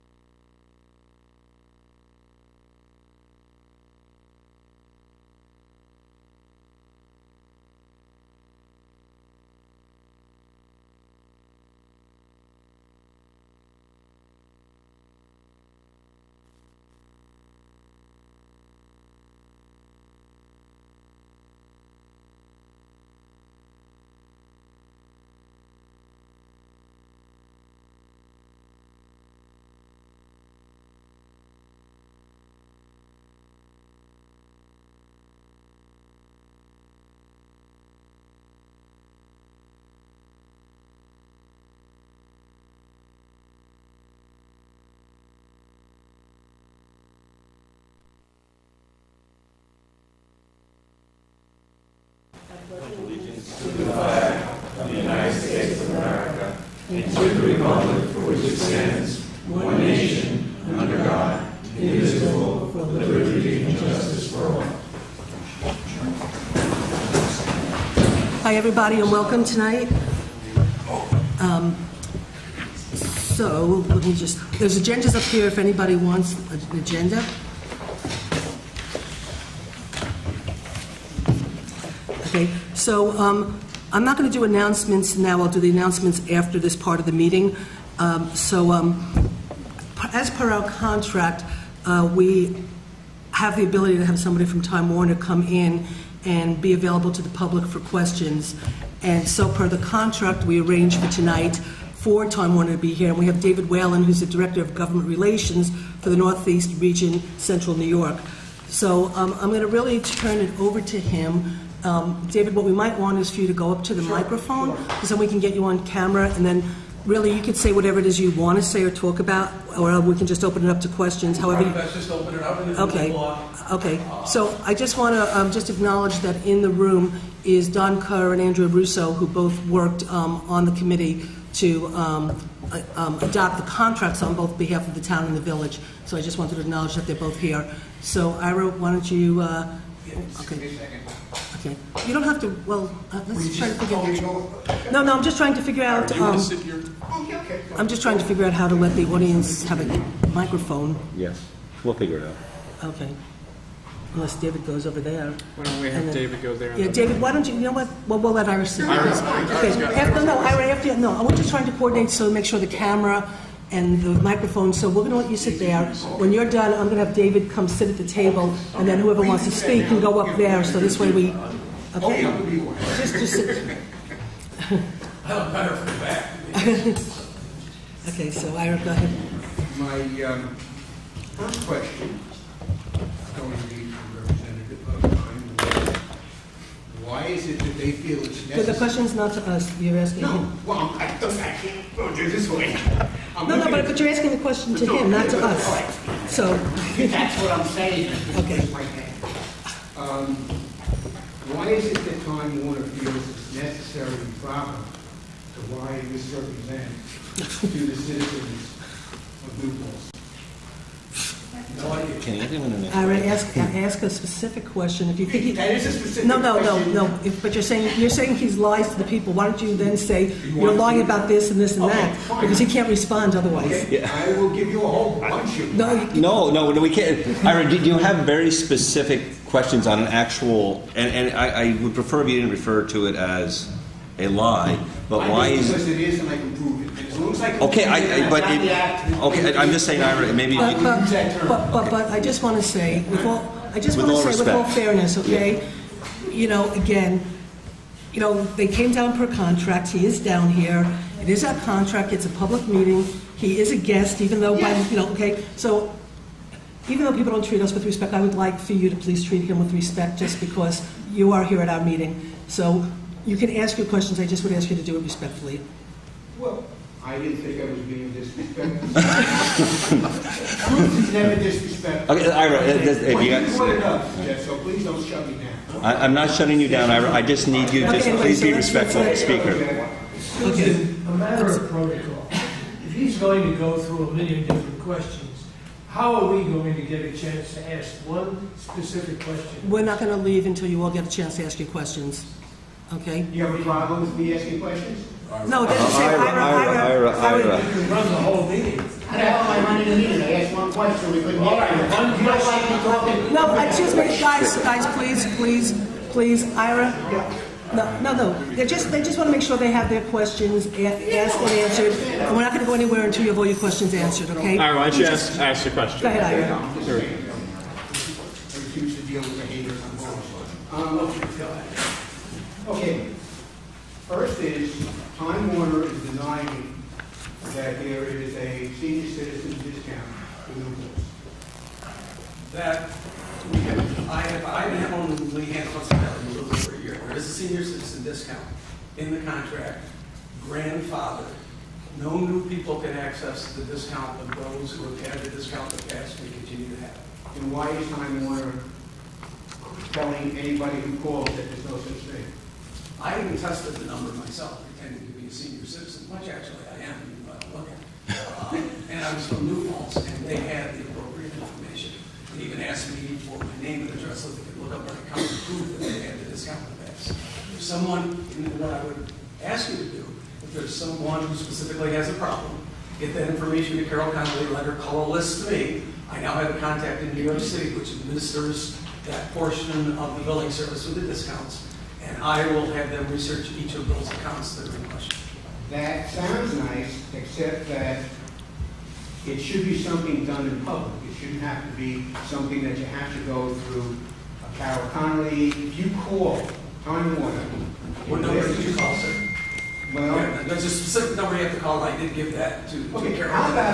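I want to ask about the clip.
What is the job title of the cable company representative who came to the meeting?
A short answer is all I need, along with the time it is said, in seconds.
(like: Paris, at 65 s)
Director of Government Relations, at 104 s.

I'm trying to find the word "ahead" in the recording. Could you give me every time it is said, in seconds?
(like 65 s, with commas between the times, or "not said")
178 s, 316 s.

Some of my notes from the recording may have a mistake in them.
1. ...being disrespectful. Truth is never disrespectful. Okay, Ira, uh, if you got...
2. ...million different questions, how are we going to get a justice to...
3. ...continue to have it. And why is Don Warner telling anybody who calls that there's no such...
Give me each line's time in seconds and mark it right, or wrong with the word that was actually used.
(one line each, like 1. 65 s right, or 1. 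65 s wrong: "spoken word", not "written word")
1. 267 s right
2. 284 s wrong: "chance", not "justice"
3. 346 s wrong: "Time", not "Don".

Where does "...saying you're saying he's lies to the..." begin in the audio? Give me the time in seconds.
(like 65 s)
217 s.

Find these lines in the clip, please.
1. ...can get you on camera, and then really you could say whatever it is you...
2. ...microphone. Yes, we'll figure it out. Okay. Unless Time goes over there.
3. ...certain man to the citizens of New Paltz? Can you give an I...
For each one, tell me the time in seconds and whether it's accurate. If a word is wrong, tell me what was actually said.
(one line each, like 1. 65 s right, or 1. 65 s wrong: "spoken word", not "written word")
1. 115 s right
2. 150 s wrong: "David", not "Time"
3. 206 s right.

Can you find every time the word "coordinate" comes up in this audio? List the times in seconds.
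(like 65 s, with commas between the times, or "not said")
161 s.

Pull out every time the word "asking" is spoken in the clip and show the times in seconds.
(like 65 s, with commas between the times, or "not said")
189 s, 194 s, 294 s.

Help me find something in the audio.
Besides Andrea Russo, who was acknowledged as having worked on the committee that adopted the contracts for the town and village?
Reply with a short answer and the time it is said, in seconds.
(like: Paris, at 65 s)
Don Kerr, at 127 s.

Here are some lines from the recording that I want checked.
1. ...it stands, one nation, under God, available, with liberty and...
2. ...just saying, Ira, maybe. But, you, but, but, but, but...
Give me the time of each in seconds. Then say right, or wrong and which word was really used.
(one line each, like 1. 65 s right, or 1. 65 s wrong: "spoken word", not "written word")
1. 58 s wrong: "indivisible", not "available"
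2. 239 s right.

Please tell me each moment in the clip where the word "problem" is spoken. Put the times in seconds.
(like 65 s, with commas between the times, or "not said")
293 s, 372 s.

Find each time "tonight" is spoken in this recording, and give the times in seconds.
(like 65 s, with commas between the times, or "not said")
69 s, 101 s.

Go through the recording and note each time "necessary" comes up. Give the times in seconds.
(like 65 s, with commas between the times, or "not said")
188 s, 203 s.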